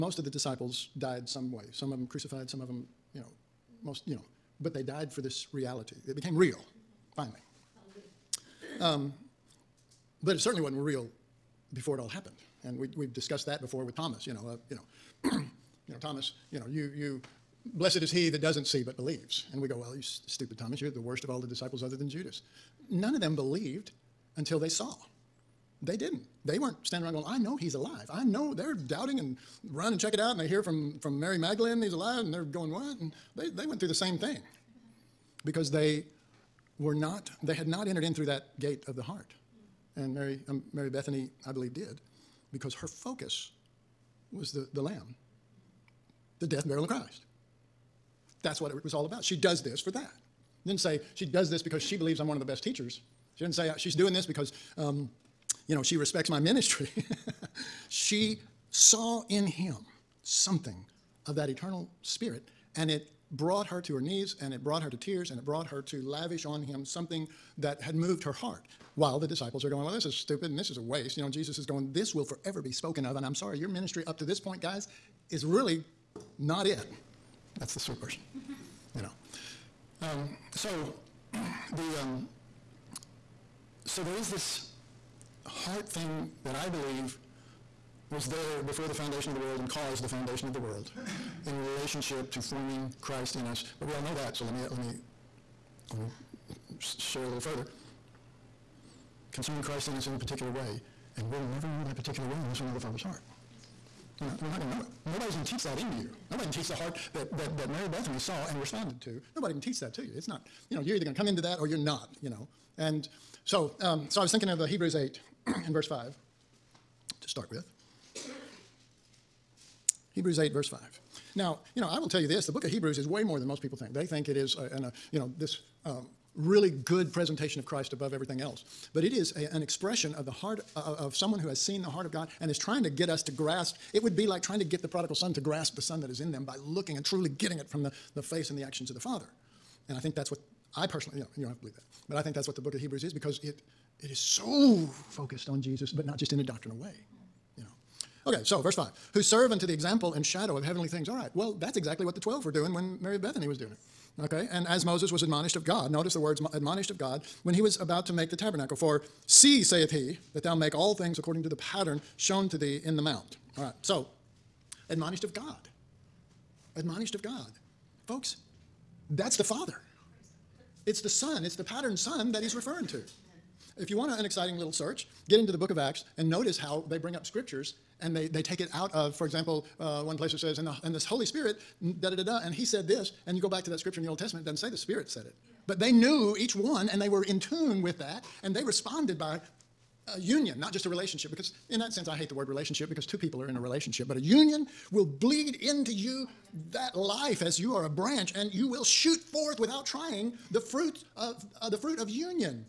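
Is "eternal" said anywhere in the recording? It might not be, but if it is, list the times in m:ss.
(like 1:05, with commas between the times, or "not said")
1:01.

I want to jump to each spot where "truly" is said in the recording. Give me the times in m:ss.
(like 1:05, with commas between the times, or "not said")
2:17.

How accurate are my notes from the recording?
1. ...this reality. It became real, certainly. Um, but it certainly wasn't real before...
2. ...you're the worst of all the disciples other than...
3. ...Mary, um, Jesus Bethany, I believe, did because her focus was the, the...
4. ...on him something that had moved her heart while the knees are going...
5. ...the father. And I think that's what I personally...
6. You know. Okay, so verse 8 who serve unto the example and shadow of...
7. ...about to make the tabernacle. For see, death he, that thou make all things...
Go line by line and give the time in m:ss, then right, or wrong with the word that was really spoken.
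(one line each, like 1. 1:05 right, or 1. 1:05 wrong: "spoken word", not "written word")
1. 0:05 wrong: "finally", not "certainly"
2. 0:20 right
3. 0:40 wrong: "Mary", not "Jesus"
4. 1:06 wrong: "disciples", not "knees"
5. 2:18 right
6. 2:27 wrong: "5", not "8"
7. 2:37 wrong: "saith", not "death".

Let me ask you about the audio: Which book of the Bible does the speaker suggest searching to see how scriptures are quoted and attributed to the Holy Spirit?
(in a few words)
Acts.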